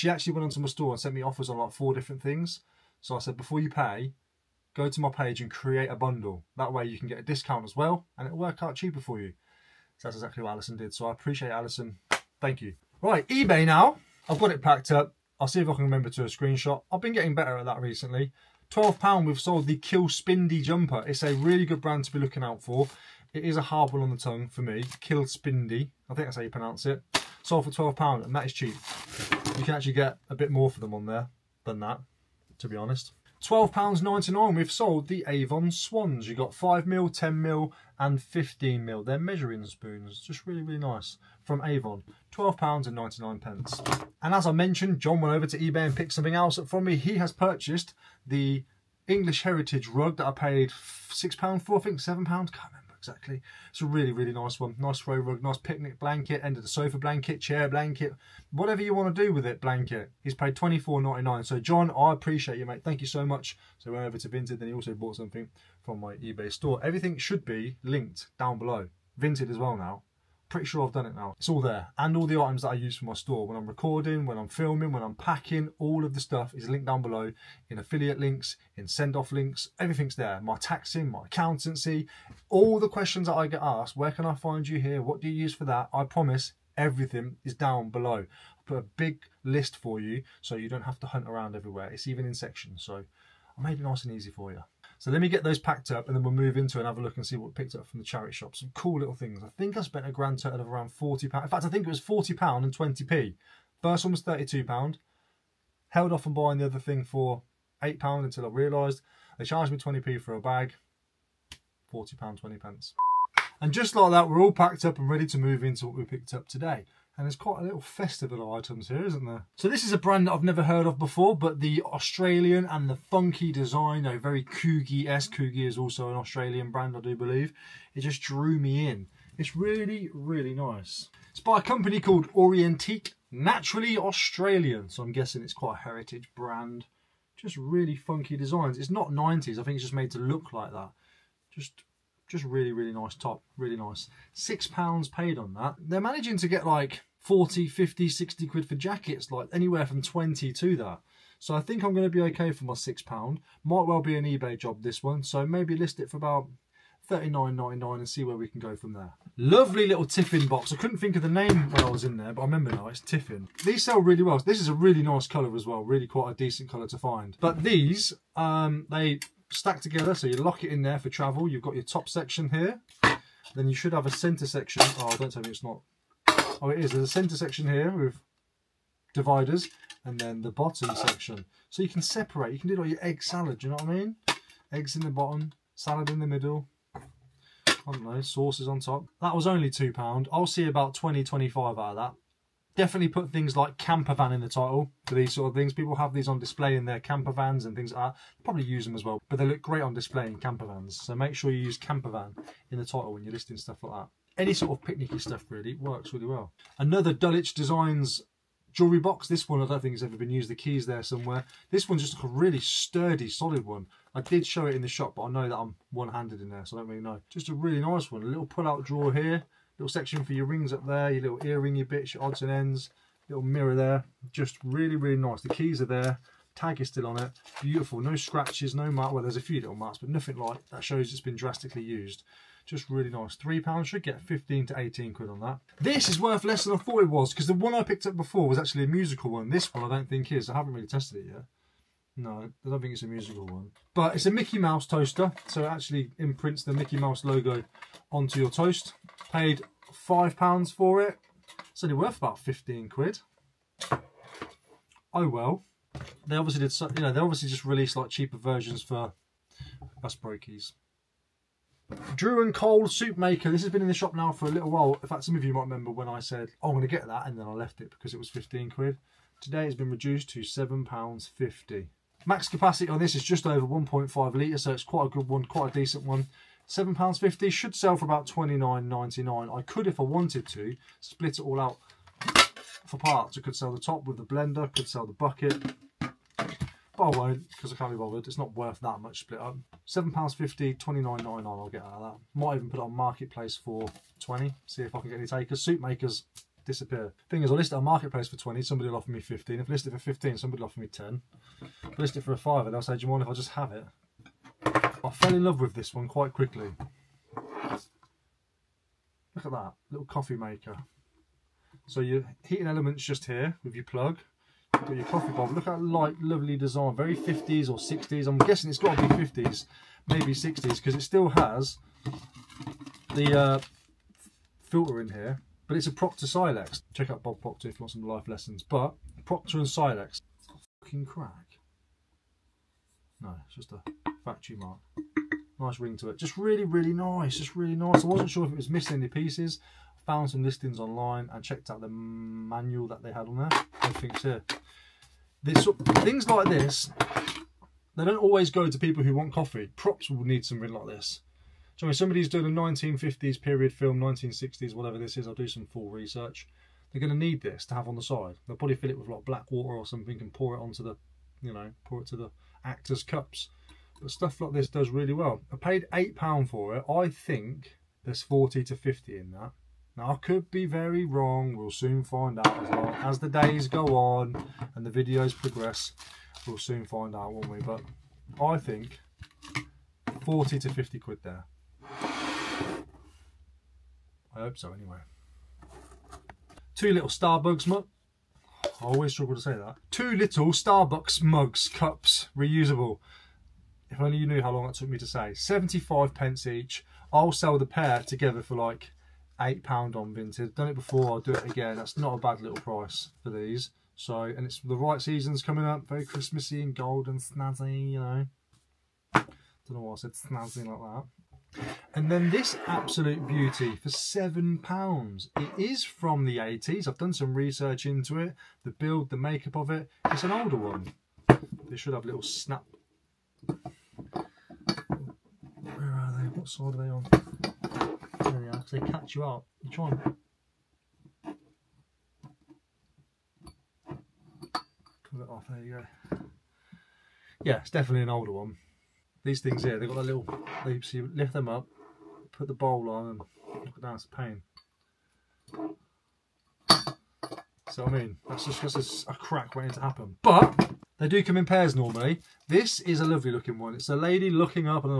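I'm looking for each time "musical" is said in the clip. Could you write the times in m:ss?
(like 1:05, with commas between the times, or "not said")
3:58, 4:03.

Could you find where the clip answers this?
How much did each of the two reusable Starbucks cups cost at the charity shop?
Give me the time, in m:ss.
6:35.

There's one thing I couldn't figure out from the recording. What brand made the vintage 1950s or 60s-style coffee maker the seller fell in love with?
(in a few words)
Proctor Silex.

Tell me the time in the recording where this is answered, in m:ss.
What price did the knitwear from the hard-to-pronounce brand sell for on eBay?
0:27.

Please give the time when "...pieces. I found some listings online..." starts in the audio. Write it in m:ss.
5:39.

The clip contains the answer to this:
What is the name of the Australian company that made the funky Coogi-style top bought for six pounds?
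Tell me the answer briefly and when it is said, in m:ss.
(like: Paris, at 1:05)
Orientique, at 2:12.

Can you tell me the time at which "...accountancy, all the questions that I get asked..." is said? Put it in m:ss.
1:21.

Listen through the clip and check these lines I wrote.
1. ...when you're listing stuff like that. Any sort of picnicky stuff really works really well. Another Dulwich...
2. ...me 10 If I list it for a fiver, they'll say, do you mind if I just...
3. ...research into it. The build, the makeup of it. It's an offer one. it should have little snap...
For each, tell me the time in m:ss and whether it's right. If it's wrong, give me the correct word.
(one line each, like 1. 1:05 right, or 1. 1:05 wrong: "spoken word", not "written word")
1. 3:23 right
2. 5:00 right
3. 6:57 wrong: "older", not "offer".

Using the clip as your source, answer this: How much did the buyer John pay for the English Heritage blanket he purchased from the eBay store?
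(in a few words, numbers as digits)
£24.99.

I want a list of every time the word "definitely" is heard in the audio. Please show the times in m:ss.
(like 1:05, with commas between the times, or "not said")
3:12, 7:17.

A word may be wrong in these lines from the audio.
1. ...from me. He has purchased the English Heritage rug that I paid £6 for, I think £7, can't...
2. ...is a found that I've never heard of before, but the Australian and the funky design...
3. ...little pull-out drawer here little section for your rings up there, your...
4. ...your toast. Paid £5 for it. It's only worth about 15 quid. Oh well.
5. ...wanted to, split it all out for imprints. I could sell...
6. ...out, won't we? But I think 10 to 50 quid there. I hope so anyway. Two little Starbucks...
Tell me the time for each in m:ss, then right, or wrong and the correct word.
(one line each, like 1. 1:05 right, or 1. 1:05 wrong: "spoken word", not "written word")
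1. 0:46 right
2. 1:59 wrong: "brand", not "found"
3. 3:38 right
4. 4:08 right
5. 4:40 wrong: "parts", not "imprints"
6. 6:17 wrong: "40", not "10".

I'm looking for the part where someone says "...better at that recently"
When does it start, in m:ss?
0:17.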